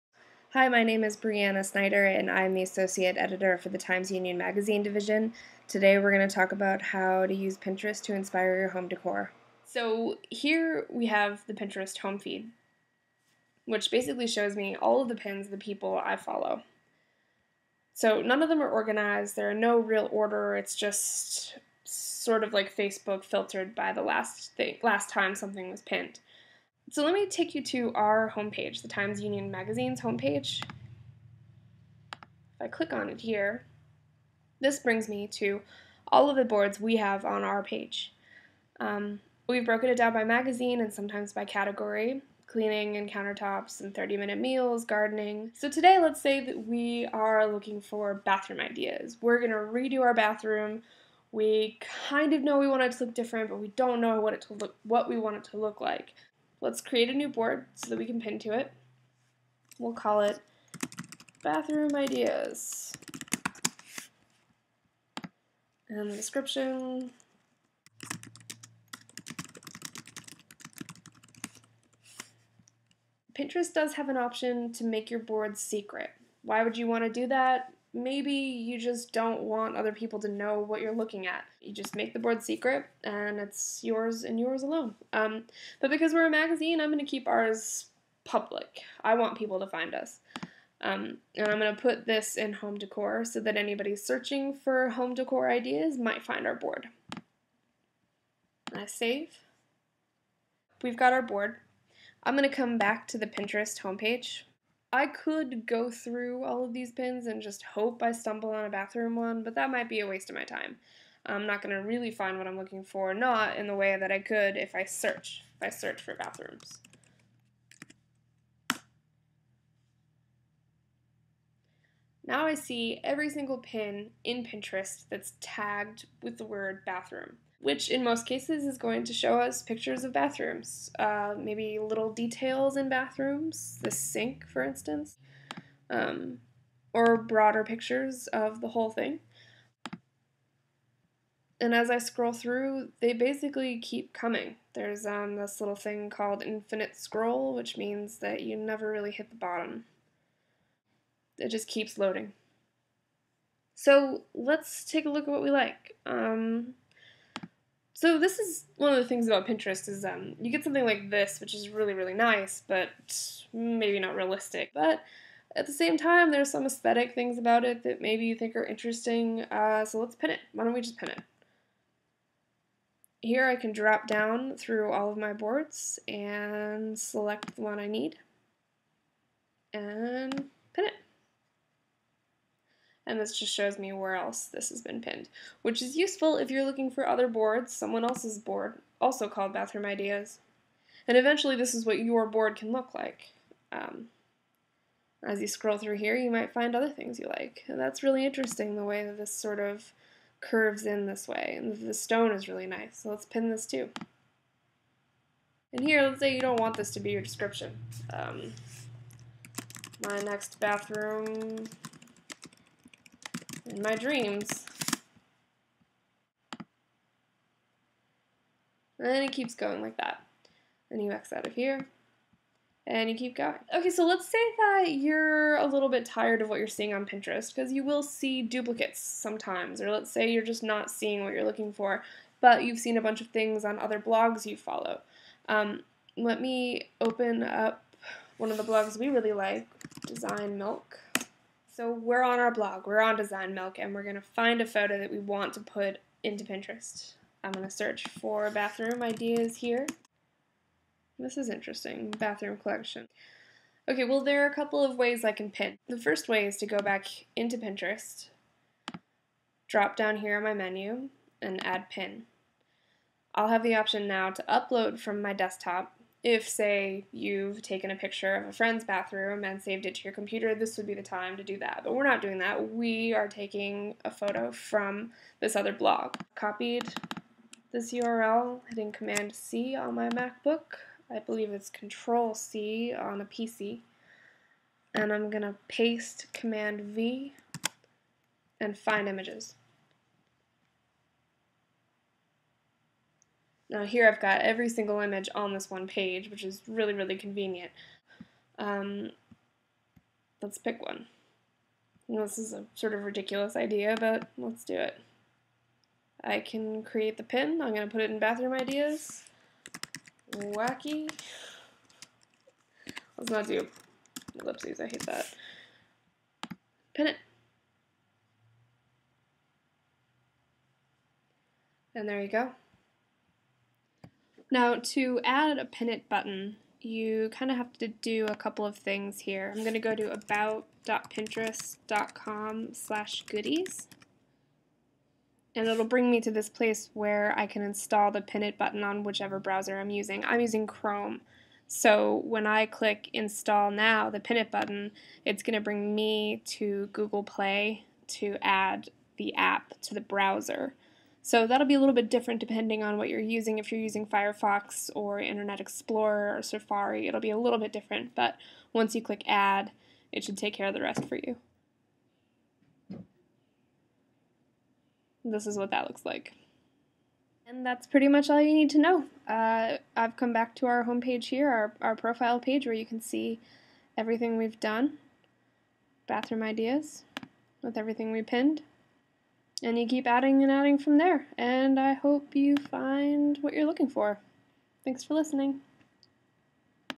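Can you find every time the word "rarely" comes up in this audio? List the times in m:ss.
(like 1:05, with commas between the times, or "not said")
not said.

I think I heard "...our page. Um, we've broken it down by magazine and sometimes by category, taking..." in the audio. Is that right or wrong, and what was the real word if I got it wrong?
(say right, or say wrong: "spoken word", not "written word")
wrong: "cleaning", not "taking".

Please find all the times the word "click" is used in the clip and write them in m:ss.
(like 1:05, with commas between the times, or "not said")
0:32, 5:42, 5:59.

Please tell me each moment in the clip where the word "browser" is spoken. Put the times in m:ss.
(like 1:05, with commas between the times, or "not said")
5:39, 5:50.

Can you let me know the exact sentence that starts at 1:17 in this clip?
maybe you just don't want other people to know what you're looking at.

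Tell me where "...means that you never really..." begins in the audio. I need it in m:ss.
2:27.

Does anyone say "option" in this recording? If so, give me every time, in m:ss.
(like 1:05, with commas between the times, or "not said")
1:14, 4:23.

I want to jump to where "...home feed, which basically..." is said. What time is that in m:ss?
0:11.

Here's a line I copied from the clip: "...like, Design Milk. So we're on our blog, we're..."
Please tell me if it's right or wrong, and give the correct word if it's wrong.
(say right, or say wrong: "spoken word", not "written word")
right.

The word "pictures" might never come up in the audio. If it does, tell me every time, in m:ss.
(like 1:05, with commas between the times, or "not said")
2:09, 2:17, 4:27.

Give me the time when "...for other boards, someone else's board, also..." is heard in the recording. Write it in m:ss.
3:06.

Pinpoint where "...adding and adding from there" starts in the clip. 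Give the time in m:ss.
6:20.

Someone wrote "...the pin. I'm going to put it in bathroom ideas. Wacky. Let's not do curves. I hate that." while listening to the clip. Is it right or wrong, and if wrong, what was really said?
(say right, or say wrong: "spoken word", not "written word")
wrong: "ellipses", not "curves".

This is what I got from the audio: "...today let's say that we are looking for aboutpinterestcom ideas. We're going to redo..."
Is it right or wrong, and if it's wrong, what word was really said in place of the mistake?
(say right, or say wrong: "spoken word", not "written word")
wrong: "bathroom", not "aboutpinterestcom".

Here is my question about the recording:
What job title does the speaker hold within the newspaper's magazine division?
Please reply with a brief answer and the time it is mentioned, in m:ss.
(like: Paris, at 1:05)
Associate Editor, at 0:02.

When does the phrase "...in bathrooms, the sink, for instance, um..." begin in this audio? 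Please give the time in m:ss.
2:12.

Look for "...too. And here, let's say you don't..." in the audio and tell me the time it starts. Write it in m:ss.
3:23.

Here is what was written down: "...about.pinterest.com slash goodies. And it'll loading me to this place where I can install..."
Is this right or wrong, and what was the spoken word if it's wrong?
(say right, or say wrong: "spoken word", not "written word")
wrong: "bring", not "loading".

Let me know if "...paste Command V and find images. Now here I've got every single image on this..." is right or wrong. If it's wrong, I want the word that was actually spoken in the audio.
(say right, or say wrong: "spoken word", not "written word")
right.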